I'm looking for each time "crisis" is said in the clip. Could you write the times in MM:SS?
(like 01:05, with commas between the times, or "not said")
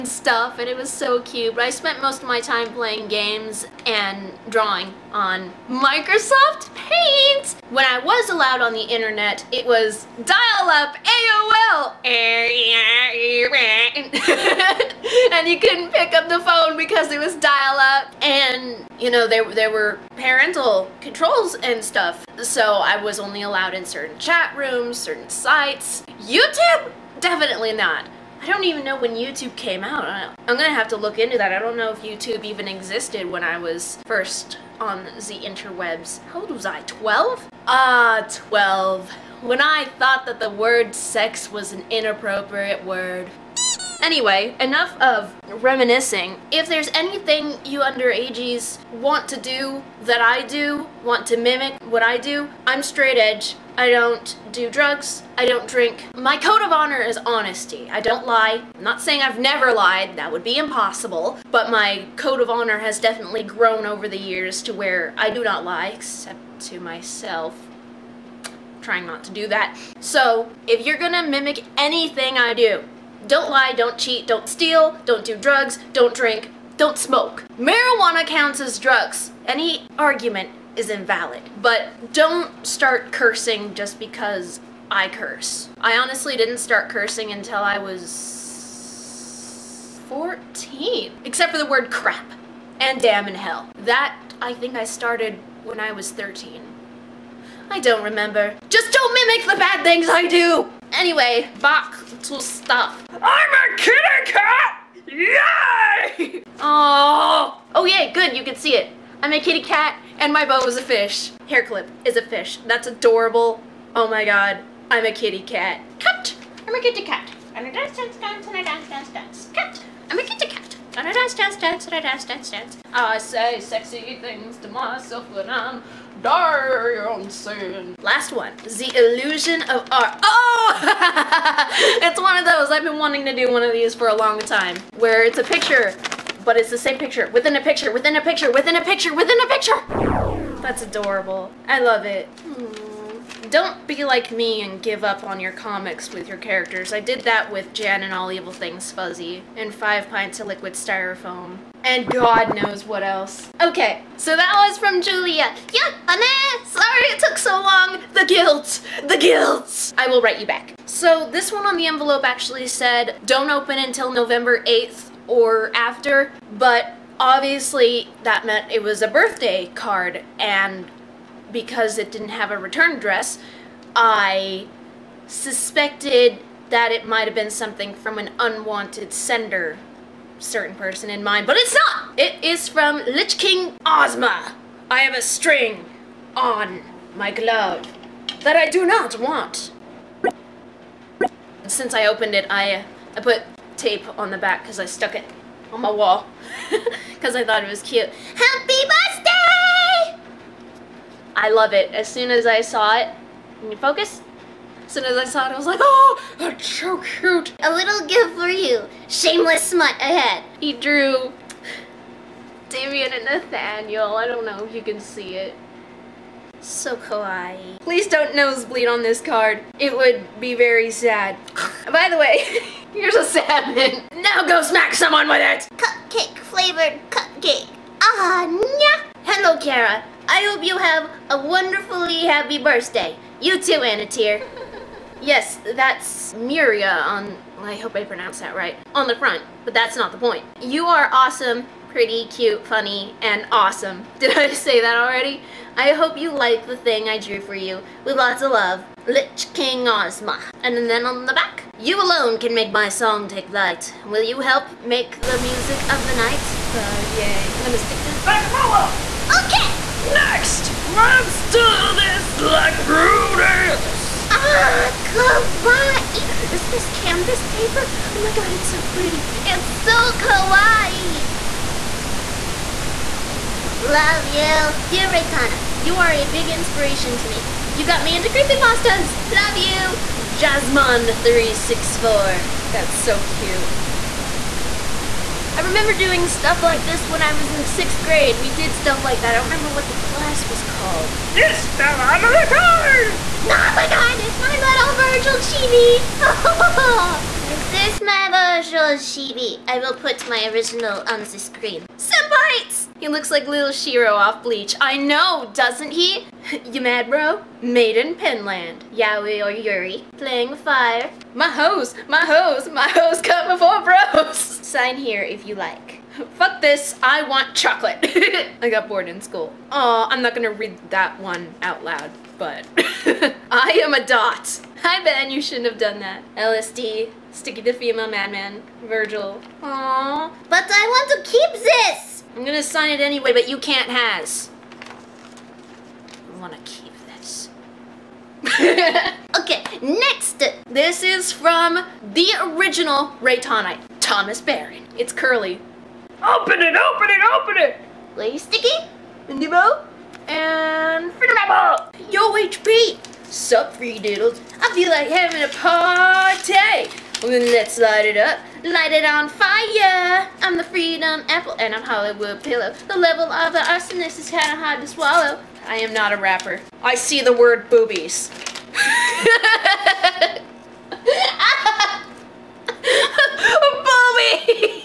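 not said.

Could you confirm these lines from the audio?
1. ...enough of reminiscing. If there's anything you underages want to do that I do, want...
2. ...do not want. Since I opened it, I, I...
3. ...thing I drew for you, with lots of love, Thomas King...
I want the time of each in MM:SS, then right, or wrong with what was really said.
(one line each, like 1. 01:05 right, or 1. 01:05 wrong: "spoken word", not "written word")
1. 00:44 right
2. 03:08 right
3. 04:06 wrong: "Lich", not "Thomas".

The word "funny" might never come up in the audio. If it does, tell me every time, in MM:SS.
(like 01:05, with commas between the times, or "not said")
04:02.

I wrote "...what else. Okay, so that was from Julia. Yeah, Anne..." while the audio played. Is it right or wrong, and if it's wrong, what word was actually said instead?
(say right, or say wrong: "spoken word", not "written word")
right.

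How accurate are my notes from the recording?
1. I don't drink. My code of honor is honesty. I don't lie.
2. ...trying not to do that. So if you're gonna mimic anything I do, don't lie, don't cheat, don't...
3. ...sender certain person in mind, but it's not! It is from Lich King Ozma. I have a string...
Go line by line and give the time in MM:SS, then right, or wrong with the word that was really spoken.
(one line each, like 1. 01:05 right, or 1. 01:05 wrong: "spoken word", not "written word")
1. 00:55 right
2. 01:08 right
3. 02:59 right.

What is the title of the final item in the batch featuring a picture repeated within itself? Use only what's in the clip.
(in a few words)
The Illusion of Art.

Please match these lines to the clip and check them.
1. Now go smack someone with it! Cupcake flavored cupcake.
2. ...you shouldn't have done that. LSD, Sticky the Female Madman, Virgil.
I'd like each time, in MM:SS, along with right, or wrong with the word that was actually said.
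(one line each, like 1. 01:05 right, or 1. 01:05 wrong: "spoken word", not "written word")
1. 03:44 right
2. 05:25 right.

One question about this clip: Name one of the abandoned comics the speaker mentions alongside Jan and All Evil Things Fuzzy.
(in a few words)
Five Pints of Liquid Styrofoam.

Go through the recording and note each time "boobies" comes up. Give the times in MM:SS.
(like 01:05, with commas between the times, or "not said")
06:07, 06:13.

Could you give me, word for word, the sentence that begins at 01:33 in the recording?
That I think I started when I was 13.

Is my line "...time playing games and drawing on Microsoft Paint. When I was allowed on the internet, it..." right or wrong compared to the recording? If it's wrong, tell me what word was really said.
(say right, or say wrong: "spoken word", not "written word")
right.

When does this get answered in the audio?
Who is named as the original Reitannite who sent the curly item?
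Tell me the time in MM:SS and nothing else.
05:43.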